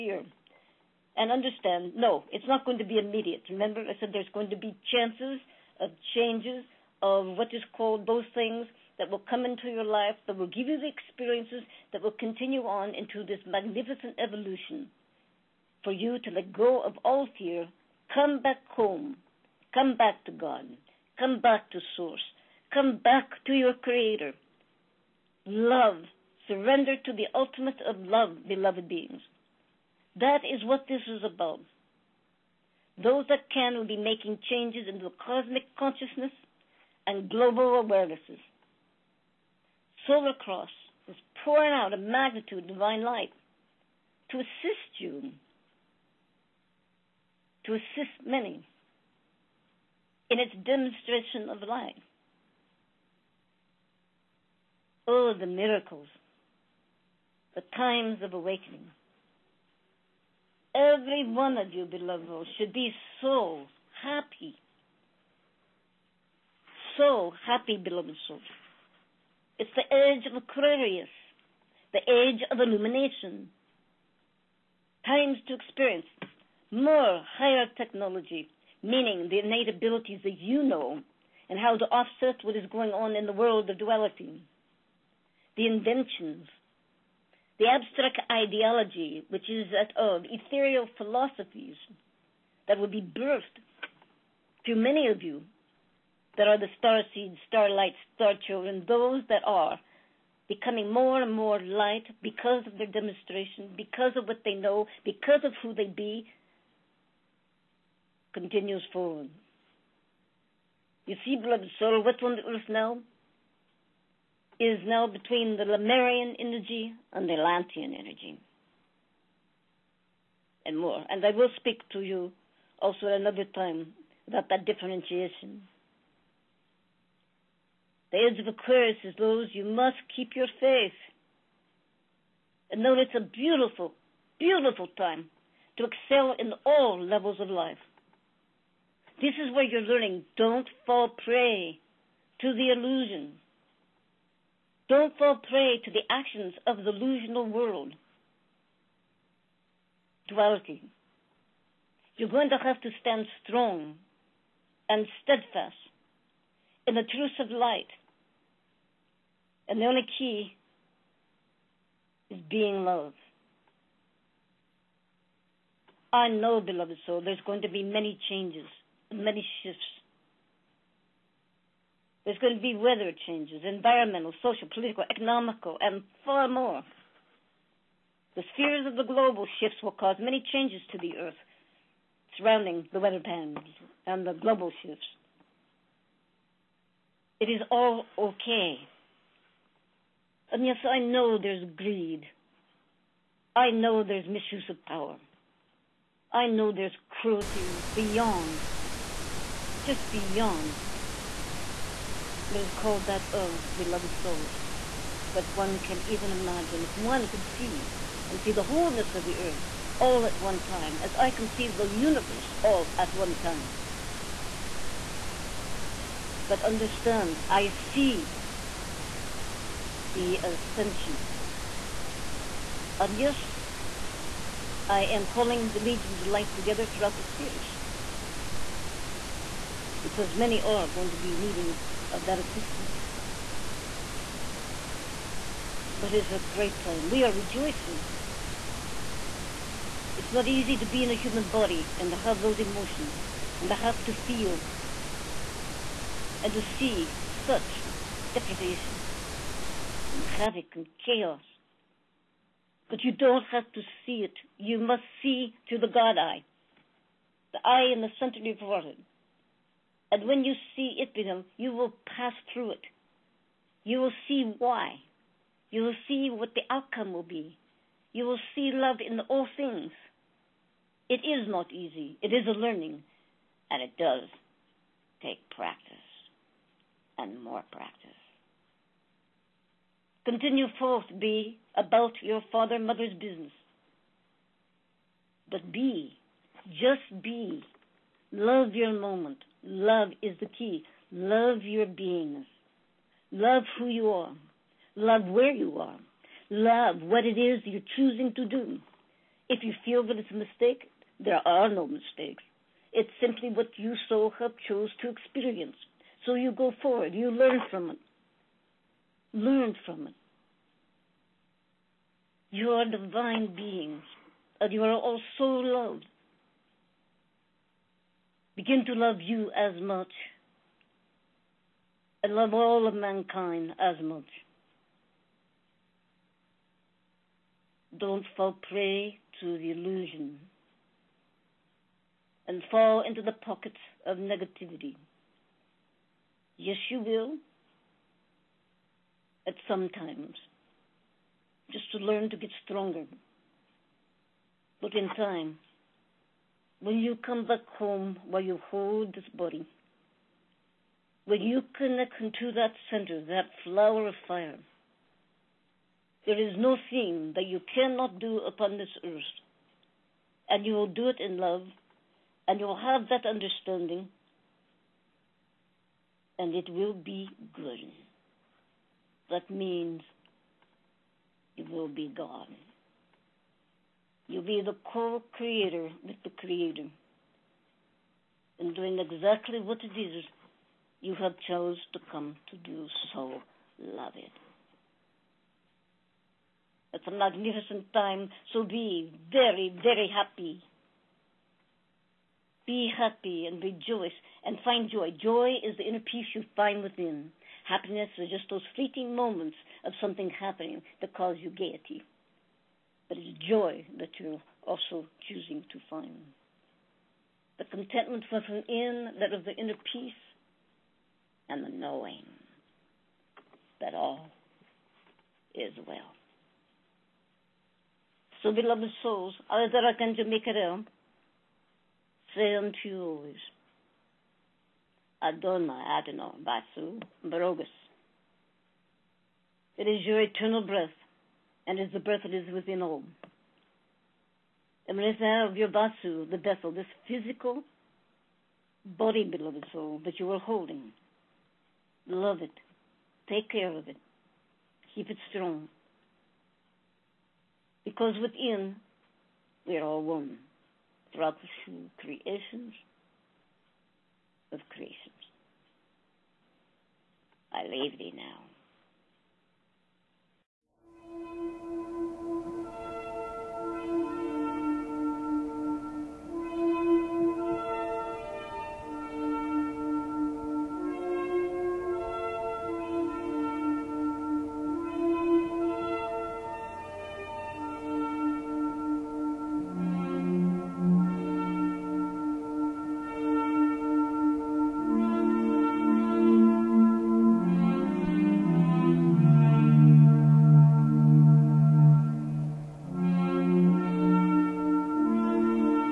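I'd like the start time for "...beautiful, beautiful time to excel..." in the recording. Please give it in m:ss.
2:13.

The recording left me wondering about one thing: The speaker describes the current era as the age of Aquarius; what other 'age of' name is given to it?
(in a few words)
age of illumination.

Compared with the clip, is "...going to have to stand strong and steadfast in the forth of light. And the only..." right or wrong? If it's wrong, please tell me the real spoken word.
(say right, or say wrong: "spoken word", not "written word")
wrong: "truth", not "forth".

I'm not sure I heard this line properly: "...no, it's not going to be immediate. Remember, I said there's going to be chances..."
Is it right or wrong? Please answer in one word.
right.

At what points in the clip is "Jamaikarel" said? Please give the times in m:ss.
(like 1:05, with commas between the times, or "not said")
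7:00.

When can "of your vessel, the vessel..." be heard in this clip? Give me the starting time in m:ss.
7:14.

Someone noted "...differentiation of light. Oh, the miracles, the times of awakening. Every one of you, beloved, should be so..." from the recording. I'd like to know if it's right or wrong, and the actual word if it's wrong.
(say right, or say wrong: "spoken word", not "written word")
wrong: "demonstration", not "differentiation".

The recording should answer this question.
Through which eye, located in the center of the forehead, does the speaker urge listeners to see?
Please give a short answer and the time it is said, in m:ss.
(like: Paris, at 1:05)
God eye, at 4:15.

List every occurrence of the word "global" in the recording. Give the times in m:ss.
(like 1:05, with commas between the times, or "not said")
0:37, 2:59, 3:04.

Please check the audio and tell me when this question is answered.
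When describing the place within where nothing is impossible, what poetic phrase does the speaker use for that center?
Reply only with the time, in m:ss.
5:53.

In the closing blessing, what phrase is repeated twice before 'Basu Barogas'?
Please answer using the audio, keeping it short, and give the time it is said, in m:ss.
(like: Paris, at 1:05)
Adonai, at 7:05.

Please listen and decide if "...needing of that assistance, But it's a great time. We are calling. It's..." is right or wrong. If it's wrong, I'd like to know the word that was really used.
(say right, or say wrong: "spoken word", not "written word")
wrong: "rejoicing", not "calling".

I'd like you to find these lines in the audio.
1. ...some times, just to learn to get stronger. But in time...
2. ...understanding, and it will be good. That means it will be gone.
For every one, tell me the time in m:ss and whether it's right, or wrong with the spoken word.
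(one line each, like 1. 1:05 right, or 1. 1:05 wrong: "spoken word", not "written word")
1. 5:39 right
2. 6:03 right.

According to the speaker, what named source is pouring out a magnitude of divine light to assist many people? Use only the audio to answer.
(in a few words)
Solar Cross.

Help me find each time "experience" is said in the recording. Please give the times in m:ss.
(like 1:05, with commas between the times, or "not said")
0:10, 1:15, 5:05.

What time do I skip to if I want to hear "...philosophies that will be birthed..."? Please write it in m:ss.
1:30.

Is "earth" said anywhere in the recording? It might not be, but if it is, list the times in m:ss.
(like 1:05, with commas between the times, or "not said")
1:52, 3:01, 3:29, 5:59.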